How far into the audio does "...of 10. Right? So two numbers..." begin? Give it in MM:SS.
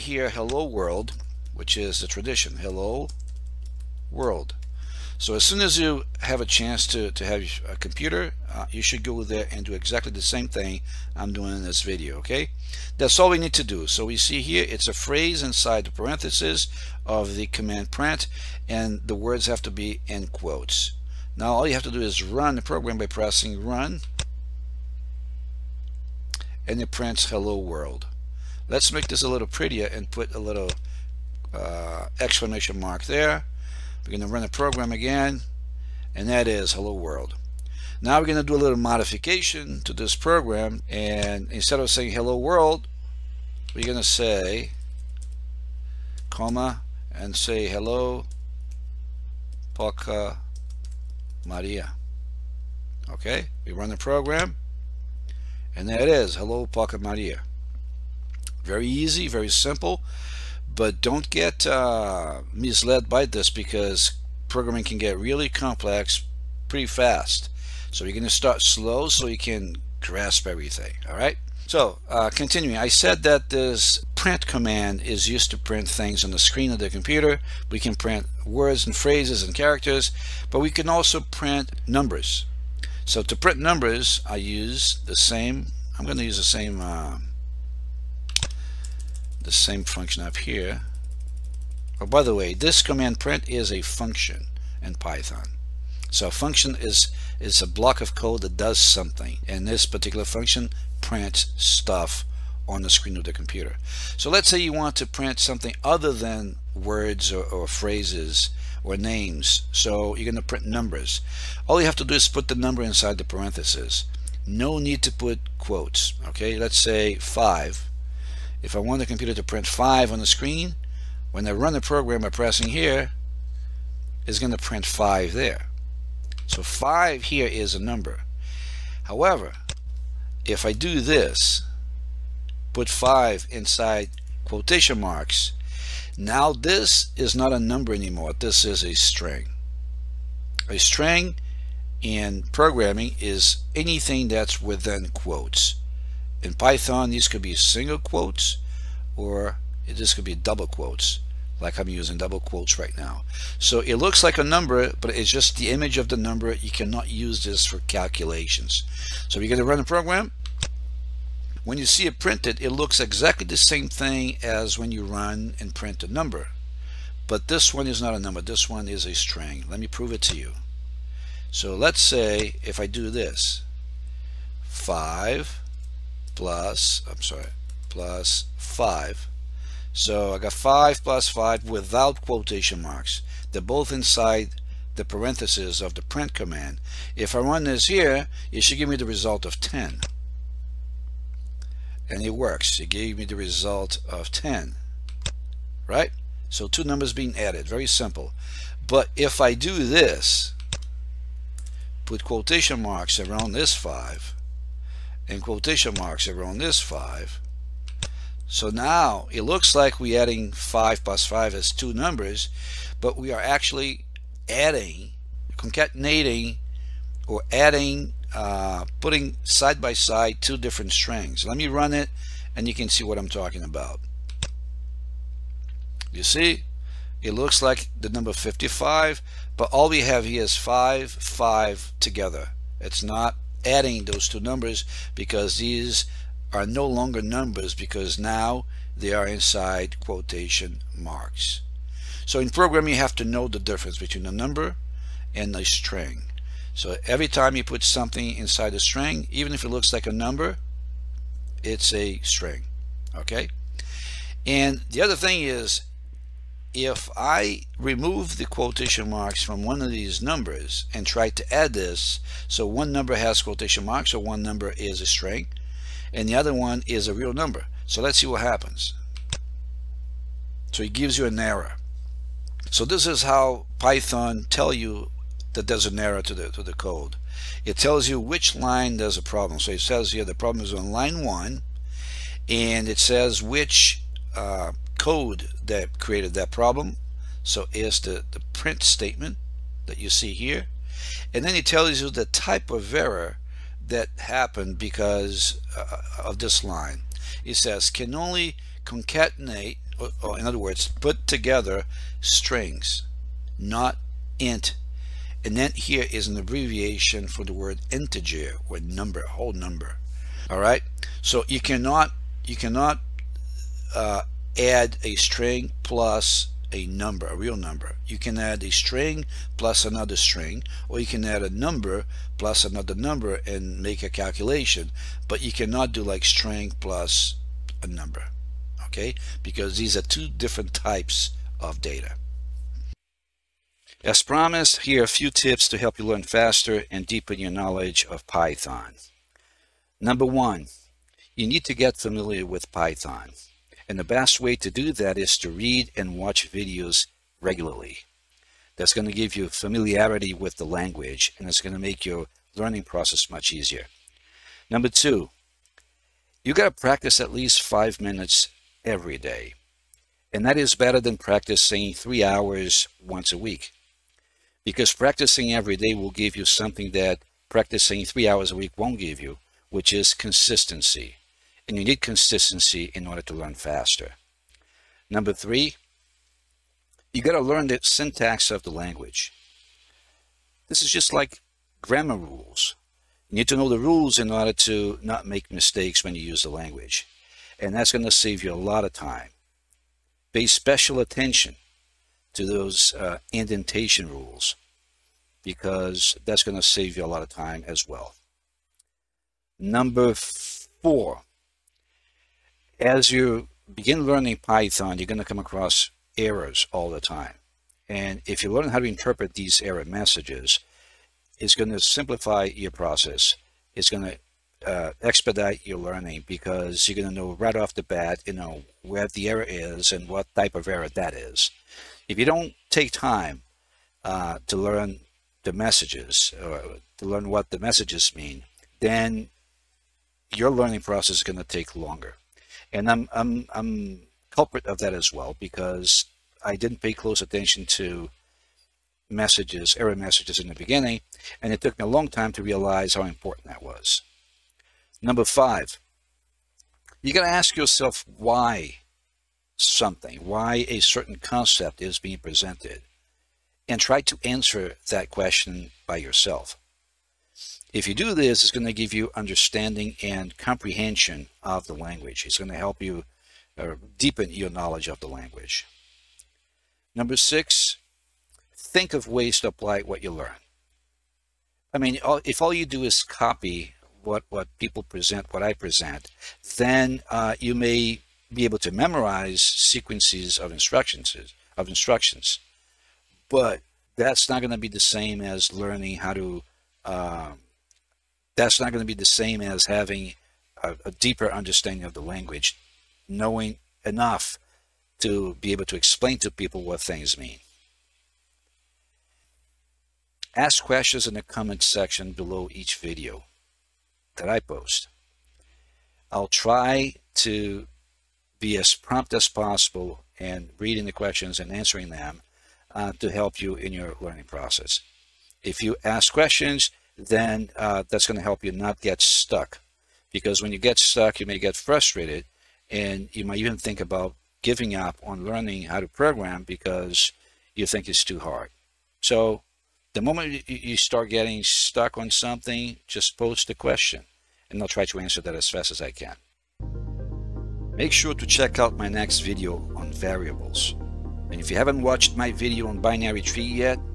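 03:14.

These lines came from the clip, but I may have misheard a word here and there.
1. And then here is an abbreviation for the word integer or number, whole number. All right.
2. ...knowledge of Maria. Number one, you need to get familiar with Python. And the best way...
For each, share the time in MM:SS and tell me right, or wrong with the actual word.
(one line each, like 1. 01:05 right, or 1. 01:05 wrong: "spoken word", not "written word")
1. 05:05 right
2. 05:37 wrong: "Python", not "Maria".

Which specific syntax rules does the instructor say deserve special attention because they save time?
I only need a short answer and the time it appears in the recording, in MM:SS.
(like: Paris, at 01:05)
indentation rules, at 06:33.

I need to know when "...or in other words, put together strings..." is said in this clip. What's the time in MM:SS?
05:00.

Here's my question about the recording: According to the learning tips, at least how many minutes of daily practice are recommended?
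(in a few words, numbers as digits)
5.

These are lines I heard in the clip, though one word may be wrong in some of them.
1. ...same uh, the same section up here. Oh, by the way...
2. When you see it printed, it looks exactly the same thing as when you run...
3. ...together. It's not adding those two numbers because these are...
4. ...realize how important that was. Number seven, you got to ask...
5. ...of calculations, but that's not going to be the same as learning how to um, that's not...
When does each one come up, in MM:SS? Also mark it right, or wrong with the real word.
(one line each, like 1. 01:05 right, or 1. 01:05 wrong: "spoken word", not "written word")
1. 01:26 wrong: "function", not "section"
2. 02:41 right
3. 03:51 right
4. 07:22 wrong: "five", not "seven"
5. 08:01 wrong: "instructions", not "calculations".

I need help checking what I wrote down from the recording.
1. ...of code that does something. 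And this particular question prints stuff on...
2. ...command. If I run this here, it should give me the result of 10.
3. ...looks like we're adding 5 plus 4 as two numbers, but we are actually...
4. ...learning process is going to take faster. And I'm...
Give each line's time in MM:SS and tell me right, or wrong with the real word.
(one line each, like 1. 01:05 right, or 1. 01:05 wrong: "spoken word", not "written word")
1. 01:38 wrong: "function", not "question"
2. 03:06 right
3. 03:29 wrong: "5", not "4"
4. 07:10 wrong: "longer", not "faster".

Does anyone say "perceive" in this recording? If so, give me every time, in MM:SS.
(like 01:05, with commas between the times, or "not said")
not said.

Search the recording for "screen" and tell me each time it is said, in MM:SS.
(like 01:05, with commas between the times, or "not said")
01:16, 01:42, 02:00.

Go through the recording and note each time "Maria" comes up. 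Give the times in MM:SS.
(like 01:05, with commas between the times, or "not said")
00:51, 00:56.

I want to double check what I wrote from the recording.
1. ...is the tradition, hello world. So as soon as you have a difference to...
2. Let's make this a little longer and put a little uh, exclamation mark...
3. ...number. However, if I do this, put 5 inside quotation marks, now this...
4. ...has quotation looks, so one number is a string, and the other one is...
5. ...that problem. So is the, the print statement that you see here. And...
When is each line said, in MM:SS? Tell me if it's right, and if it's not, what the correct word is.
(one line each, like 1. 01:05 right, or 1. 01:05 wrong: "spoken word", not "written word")
1. 00:01 wrong: "chance", not "difference"
2. 00:28 wrong: "prettier", not "longer"
3. 02:07 right
4. 04:23 wrong: "marks", not "looks"
5. 04:46 right.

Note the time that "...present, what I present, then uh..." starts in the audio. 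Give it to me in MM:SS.
07:54.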